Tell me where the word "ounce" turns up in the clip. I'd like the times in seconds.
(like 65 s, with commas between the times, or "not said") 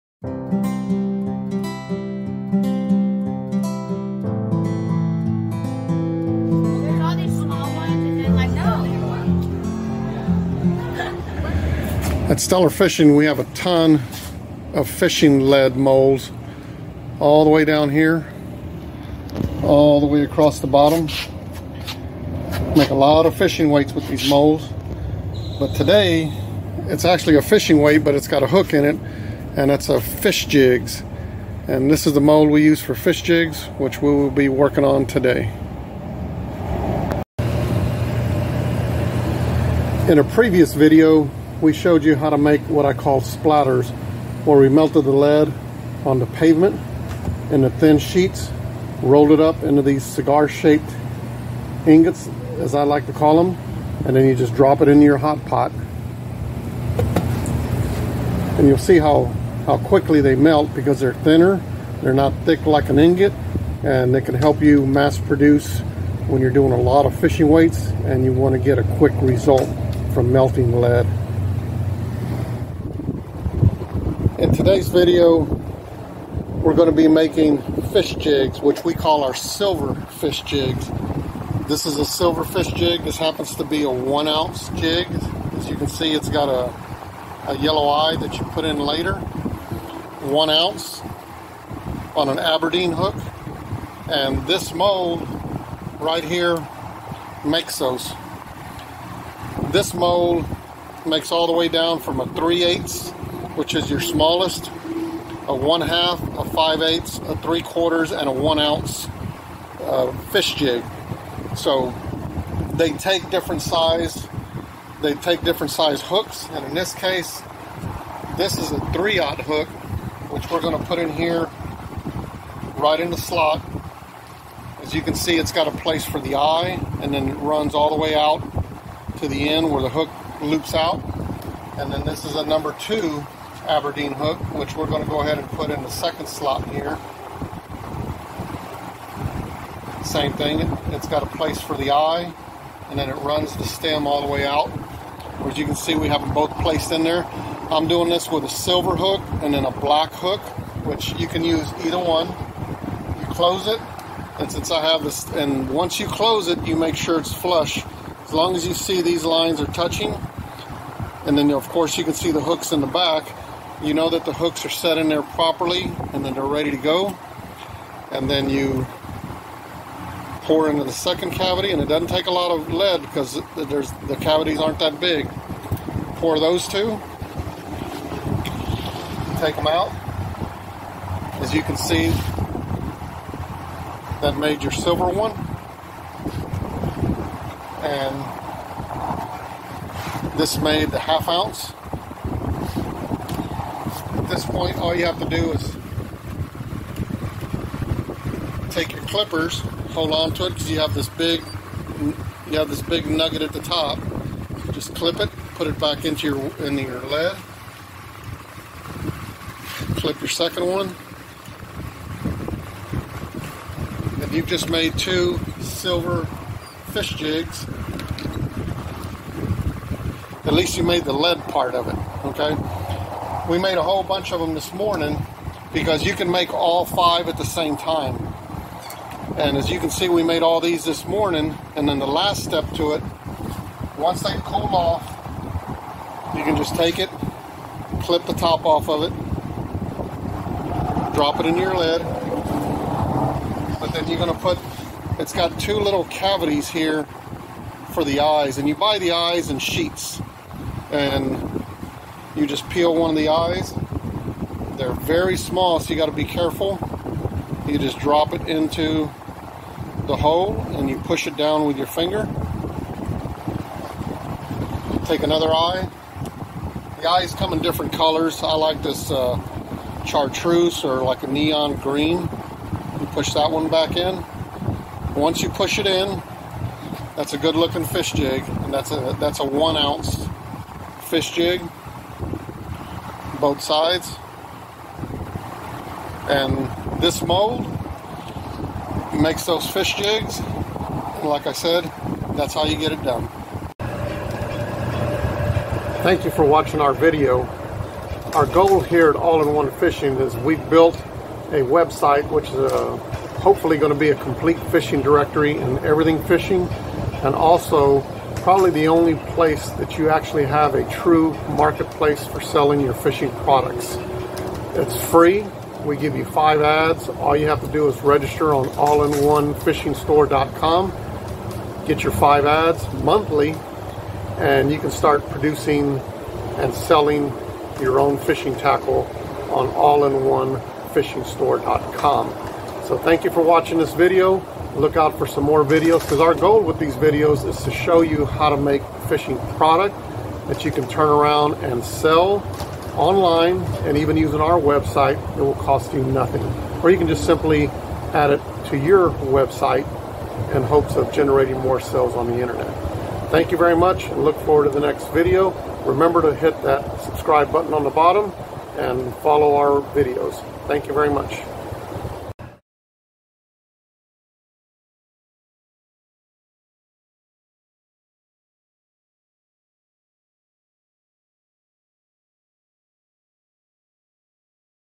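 84 s, 90 s, 108 s, 191 s, 279 s.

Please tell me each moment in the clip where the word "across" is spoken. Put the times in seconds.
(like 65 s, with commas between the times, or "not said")
20 s.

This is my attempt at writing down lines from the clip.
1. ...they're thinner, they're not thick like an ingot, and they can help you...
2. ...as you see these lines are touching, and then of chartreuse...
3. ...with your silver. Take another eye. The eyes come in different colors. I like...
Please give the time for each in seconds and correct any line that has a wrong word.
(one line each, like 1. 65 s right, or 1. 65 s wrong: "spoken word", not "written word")
1. 60 s right
2. 158 s wrong: "course", not "chartreuse"
3. 261 s wrong: "finger", not "silver".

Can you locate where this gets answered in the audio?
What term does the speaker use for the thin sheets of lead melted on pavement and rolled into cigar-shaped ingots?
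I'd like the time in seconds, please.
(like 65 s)
43 s.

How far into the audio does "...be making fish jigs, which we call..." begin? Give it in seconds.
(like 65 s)
76 s.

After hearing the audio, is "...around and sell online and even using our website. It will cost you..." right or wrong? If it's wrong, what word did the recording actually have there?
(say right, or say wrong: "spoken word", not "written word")
right.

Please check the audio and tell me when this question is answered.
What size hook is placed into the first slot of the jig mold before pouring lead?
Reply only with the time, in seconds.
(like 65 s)
118 s.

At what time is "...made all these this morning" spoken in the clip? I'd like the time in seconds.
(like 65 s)
230 s.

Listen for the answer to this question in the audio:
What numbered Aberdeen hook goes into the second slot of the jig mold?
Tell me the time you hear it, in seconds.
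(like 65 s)
132 s.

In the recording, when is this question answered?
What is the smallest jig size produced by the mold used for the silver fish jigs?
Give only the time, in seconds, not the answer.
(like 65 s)
102 s.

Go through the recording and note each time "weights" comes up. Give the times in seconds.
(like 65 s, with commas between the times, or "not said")
23 s, 27 s, 67 s.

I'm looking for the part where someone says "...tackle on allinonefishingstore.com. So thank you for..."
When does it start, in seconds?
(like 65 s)
328 s.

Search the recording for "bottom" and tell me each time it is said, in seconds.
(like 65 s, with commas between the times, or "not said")
20 s, 357 s.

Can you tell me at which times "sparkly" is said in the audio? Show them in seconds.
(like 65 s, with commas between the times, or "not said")
not said.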